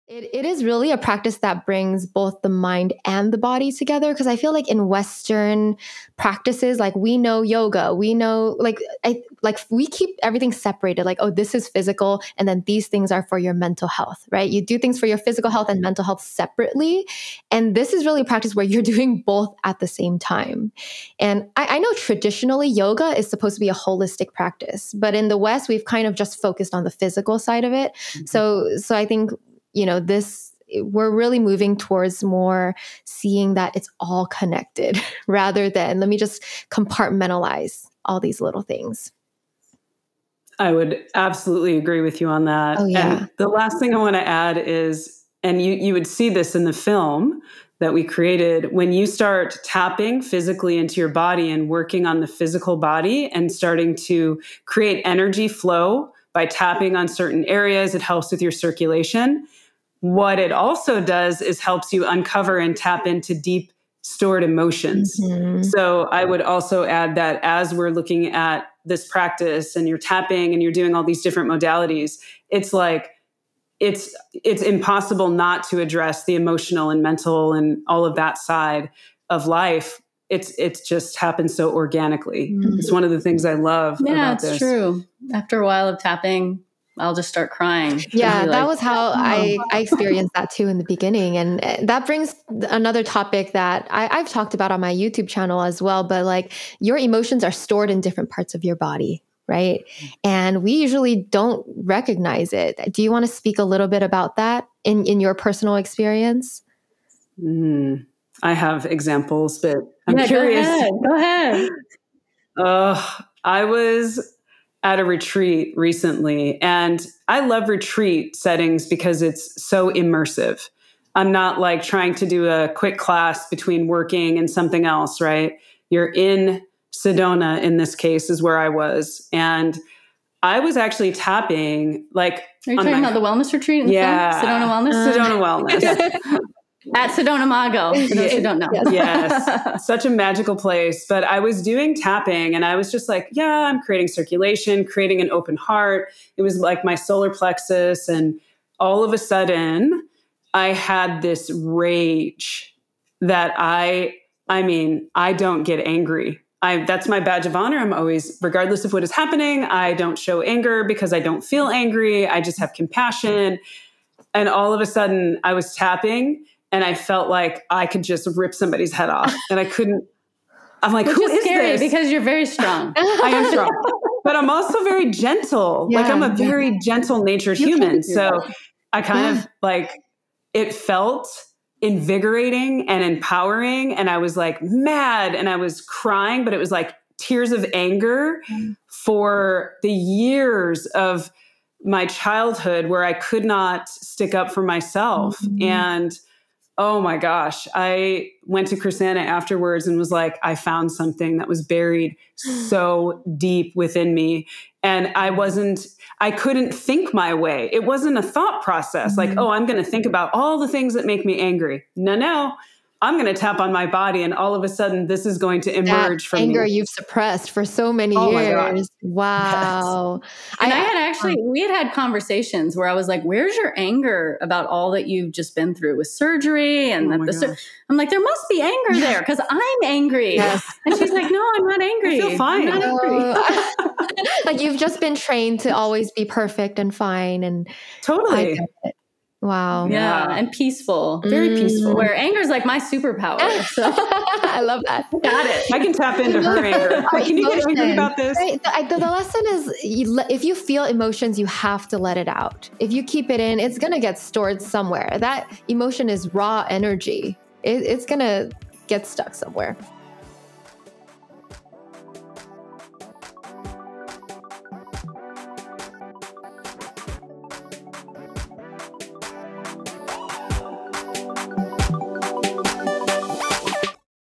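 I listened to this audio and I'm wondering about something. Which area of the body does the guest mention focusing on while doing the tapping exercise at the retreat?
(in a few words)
Solar plexus.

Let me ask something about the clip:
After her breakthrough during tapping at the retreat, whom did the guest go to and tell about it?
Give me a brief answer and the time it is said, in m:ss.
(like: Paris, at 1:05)
Krisanna, at 3:18.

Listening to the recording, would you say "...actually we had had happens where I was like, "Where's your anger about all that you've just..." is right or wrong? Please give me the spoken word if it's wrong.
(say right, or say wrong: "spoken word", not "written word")
wrong: "conversations", not "happens".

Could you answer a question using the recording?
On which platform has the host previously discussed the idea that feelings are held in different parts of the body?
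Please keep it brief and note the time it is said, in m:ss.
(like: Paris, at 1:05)
YouTube, at 1:34.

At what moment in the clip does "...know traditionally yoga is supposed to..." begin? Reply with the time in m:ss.
0:21.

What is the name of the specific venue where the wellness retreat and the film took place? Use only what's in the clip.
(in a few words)
Sedona Mago.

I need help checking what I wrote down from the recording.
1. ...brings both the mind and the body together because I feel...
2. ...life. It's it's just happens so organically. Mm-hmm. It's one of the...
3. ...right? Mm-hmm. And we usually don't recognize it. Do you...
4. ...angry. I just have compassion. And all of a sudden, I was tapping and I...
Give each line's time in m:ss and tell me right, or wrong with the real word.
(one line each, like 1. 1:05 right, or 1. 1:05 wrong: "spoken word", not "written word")
1. 0:01 right
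2. 1:19 right
3. 1:39 right
4. 2:41 right.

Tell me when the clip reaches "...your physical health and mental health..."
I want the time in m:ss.
0:15.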